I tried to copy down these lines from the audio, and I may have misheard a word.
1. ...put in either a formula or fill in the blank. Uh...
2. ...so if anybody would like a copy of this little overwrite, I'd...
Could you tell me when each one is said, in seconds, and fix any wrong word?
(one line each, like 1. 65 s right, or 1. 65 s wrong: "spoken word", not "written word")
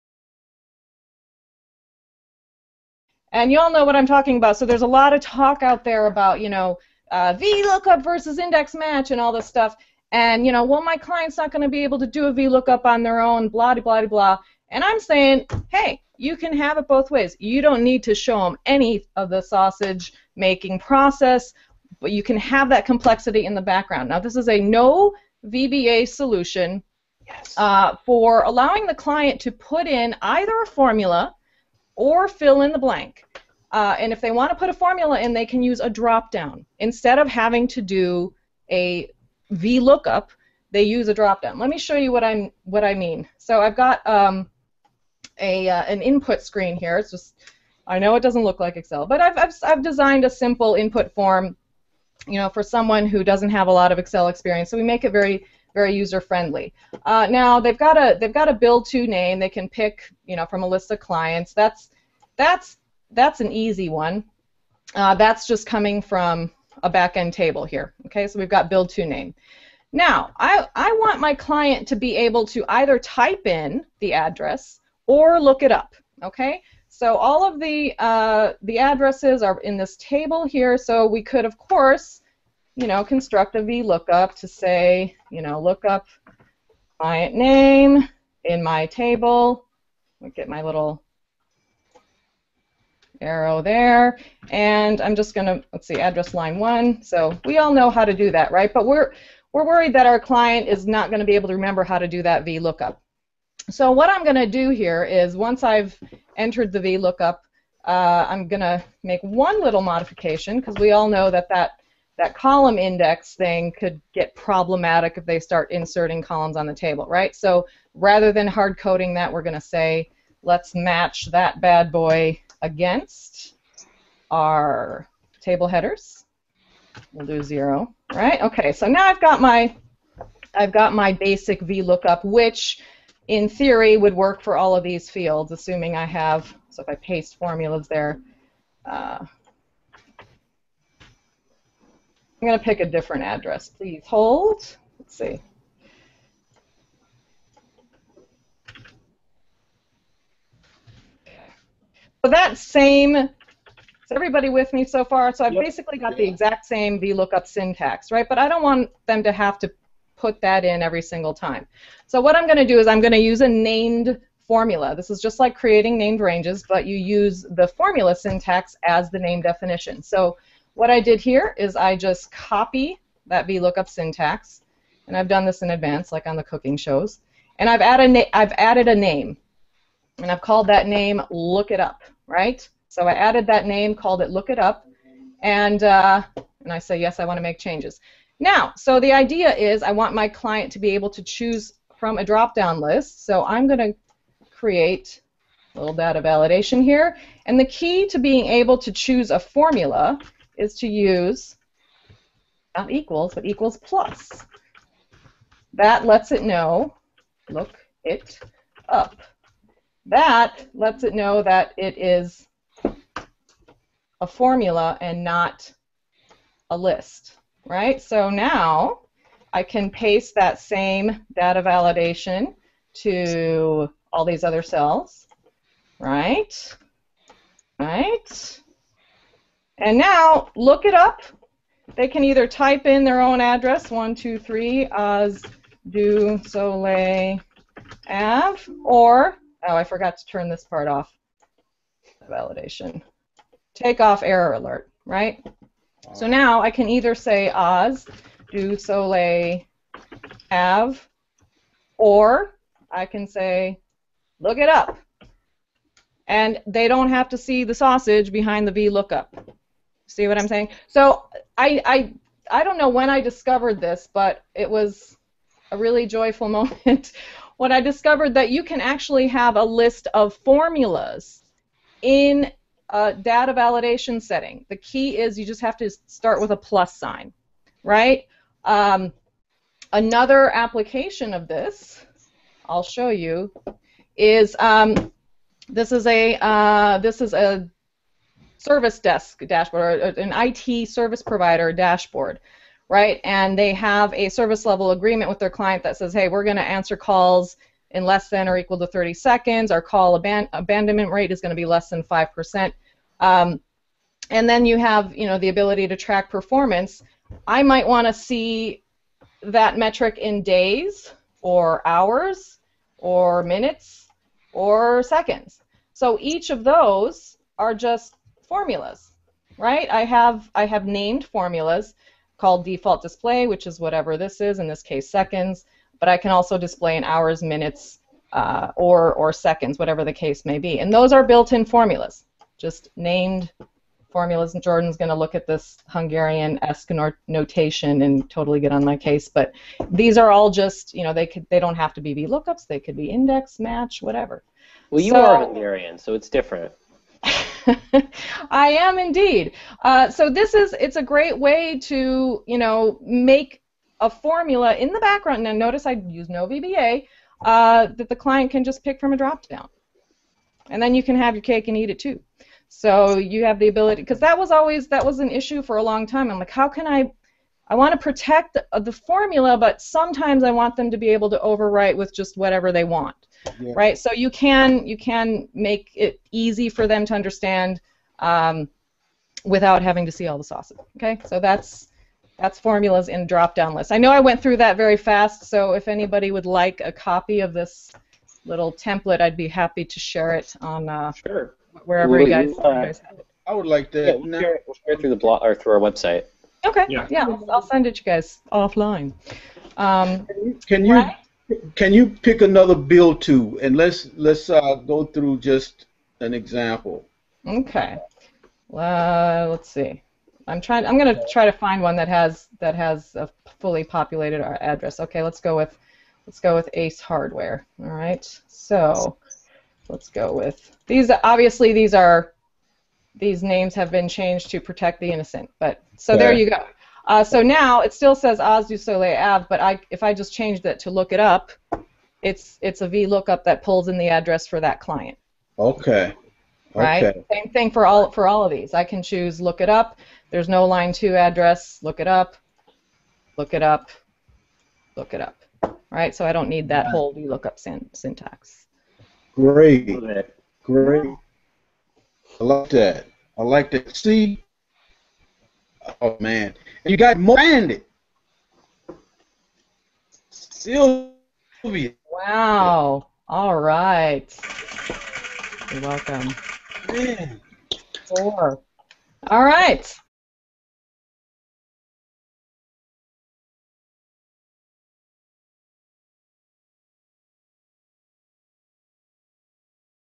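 1. 29 s right
2. 385 s wrong: "template", not "overwrite".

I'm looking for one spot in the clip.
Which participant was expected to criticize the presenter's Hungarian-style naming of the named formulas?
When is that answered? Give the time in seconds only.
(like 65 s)
334 s.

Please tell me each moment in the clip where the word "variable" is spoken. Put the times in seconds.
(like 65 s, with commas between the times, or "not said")
not said.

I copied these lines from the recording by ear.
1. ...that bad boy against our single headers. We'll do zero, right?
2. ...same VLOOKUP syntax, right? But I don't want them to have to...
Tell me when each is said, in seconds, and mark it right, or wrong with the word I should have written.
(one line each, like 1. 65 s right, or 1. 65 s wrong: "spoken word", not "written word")
1. 121 s wrong: "table", not "single"
2. 156 s right.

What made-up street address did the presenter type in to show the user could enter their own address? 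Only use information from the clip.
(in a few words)
123 Oz du Soleil Ave.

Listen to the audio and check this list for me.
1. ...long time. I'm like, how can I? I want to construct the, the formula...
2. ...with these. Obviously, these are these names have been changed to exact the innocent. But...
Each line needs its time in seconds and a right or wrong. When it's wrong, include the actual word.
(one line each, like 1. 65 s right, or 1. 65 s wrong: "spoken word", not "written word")
1. 365 s wrong: "protect", not "construct"
2. 420 s wrong: "protect", not "exact".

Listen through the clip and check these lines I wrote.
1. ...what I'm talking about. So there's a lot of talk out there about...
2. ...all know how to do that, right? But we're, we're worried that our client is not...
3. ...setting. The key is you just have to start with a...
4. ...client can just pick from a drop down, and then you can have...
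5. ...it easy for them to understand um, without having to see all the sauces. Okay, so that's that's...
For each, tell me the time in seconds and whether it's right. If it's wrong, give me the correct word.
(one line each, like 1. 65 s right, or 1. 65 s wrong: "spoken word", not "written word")
1. 3 s right
2. 97 s right
3. 274 s right
4. 358 s right
5. 375 s right.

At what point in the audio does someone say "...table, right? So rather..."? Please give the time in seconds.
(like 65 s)
116 s.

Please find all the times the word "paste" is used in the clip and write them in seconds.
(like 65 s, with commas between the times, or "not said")
136 s, 219 s.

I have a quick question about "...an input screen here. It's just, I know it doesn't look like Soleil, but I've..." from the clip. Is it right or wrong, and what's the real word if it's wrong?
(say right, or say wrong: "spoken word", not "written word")
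wrong: "Excel", not "Soleil".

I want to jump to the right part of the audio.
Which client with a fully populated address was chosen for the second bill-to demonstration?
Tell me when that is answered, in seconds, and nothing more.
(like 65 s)
416 s.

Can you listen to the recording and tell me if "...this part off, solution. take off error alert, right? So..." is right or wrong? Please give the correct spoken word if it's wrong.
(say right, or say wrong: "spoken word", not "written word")
wrong: "validation", not "solution".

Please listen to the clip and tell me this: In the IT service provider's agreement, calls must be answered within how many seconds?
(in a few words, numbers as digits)
30 seconds.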